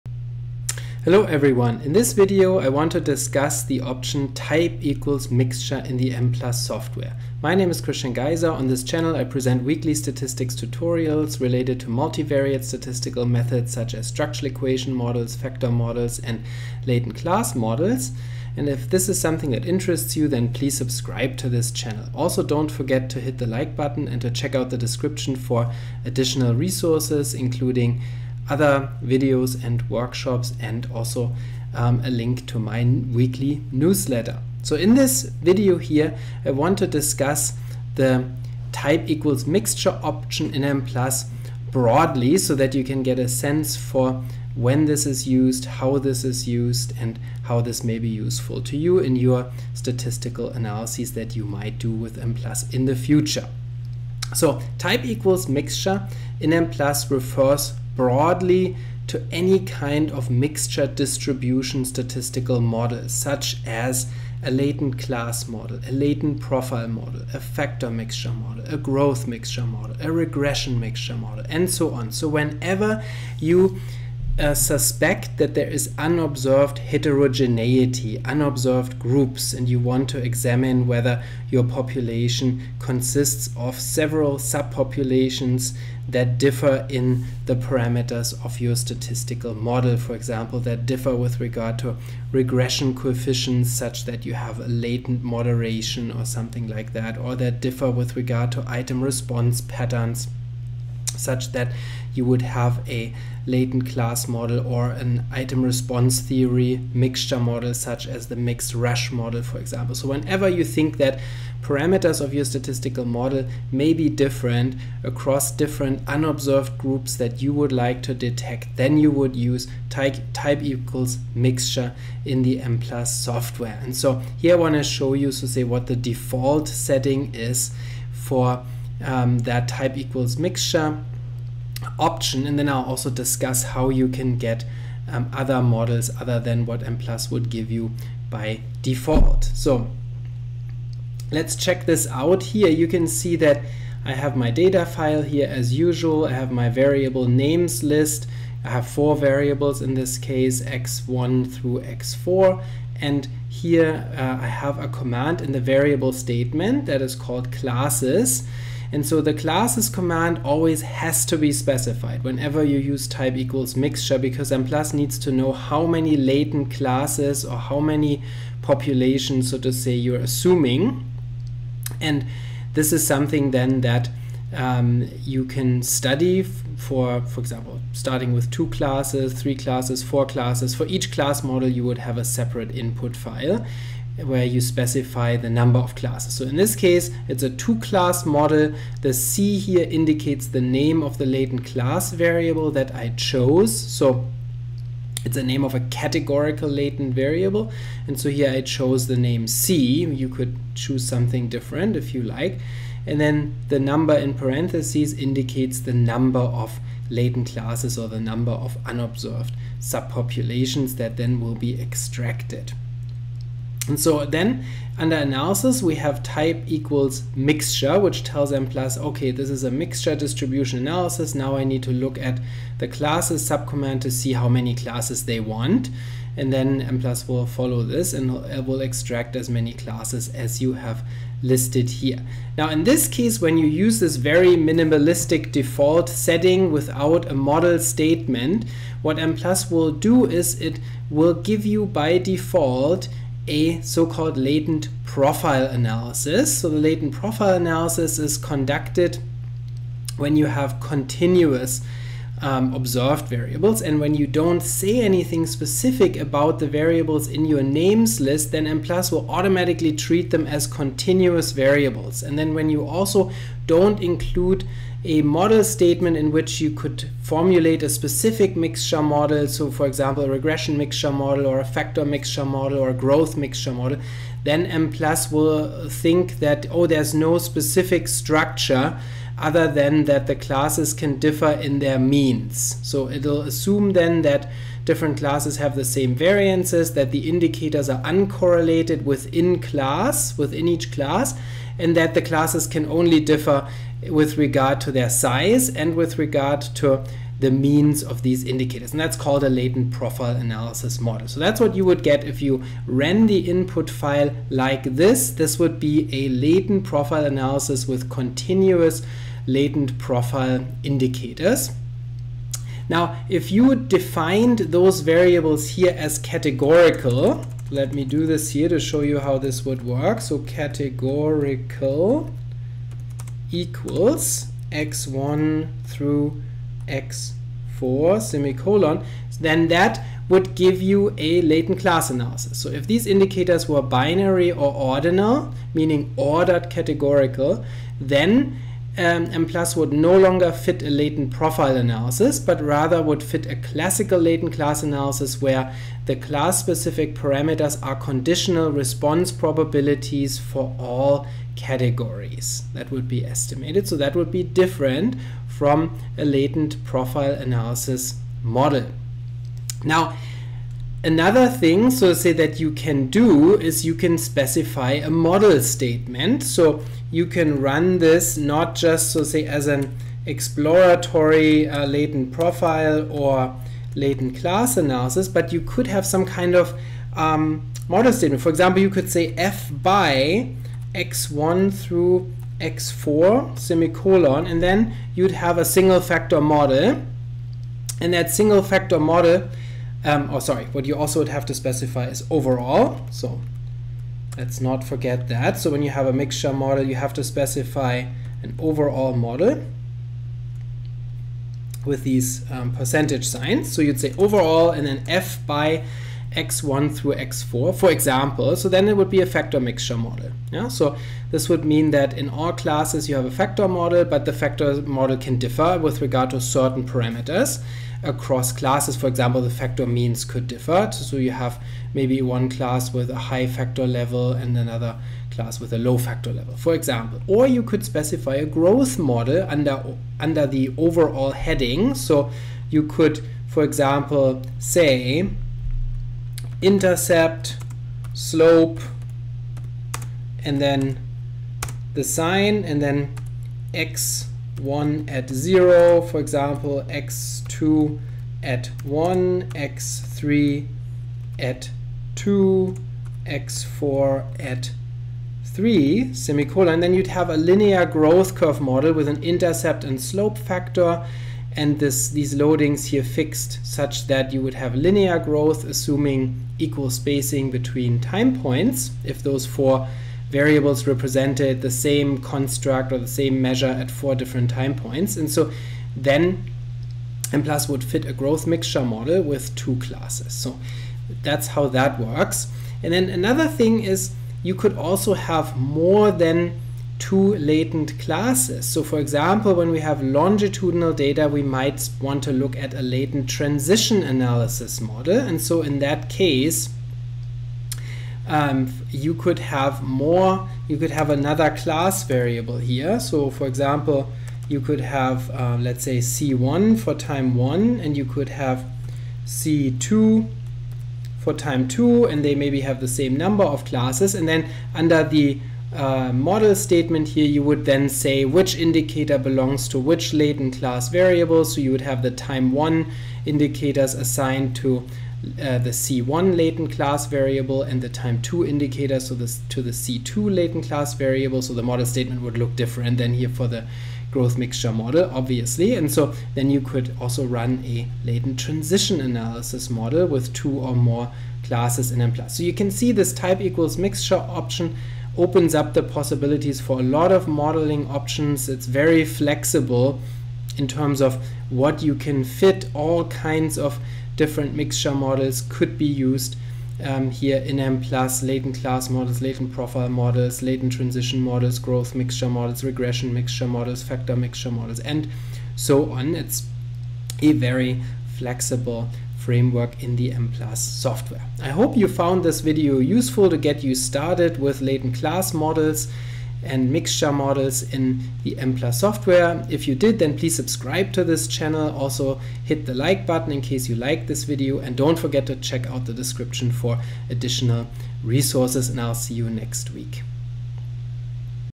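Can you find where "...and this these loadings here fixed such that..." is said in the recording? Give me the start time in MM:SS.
07:41.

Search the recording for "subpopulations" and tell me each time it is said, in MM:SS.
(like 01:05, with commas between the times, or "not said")
01:24, 03:29.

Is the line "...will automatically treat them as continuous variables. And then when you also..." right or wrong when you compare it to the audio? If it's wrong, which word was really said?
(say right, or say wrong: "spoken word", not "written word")
right.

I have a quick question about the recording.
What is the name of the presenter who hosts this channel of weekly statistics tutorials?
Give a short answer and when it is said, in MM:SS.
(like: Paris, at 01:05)
Christian Geiser, at 00:07.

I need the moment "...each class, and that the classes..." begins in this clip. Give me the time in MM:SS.
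04:50.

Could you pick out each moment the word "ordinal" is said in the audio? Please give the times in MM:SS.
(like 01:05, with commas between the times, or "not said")
05:34.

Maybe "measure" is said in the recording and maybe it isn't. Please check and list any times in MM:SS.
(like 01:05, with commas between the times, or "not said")
07:53.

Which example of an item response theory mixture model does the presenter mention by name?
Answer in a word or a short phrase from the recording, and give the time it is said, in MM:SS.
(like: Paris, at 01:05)
mixed Rasch model, at 01:48.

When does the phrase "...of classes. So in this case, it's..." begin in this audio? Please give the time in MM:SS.
03:05.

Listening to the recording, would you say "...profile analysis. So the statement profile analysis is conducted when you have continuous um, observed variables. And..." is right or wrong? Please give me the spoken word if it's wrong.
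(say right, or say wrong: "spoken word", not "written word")
wrong: "latent", not "statement".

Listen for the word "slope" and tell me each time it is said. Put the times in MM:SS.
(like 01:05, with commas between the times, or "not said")
07:18, 07:40.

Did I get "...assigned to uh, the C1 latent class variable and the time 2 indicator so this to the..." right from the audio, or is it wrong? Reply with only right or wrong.
right.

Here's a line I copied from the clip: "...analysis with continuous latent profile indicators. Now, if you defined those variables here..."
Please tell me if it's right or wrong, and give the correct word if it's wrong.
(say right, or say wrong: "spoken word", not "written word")
right.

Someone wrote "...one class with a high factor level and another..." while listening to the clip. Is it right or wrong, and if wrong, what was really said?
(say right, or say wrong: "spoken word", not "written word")
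right.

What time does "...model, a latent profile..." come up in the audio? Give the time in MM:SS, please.
01:05.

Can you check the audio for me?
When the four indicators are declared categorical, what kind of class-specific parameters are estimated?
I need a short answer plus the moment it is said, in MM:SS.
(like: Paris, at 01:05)
conditional response probabilities, at 05:47.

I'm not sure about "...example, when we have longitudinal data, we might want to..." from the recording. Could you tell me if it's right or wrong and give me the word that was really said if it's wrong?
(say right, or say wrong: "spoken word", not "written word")
right.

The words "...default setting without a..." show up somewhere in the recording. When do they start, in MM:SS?
03:55.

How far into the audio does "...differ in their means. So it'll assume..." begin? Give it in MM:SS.
04:41.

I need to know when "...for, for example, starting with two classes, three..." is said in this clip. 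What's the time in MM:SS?
02:56.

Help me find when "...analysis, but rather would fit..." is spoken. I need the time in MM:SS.
05:41.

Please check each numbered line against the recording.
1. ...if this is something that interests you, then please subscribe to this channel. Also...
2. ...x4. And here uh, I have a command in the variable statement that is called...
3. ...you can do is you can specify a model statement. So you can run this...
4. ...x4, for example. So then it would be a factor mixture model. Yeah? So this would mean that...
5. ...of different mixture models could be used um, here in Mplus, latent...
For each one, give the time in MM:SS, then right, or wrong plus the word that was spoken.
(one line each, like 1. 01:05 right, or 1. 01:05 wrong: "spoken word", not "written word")
1. 00:18 right
2. 02:31 right
3. 06:02 right
4. 06:47 right
5. 09:13 right.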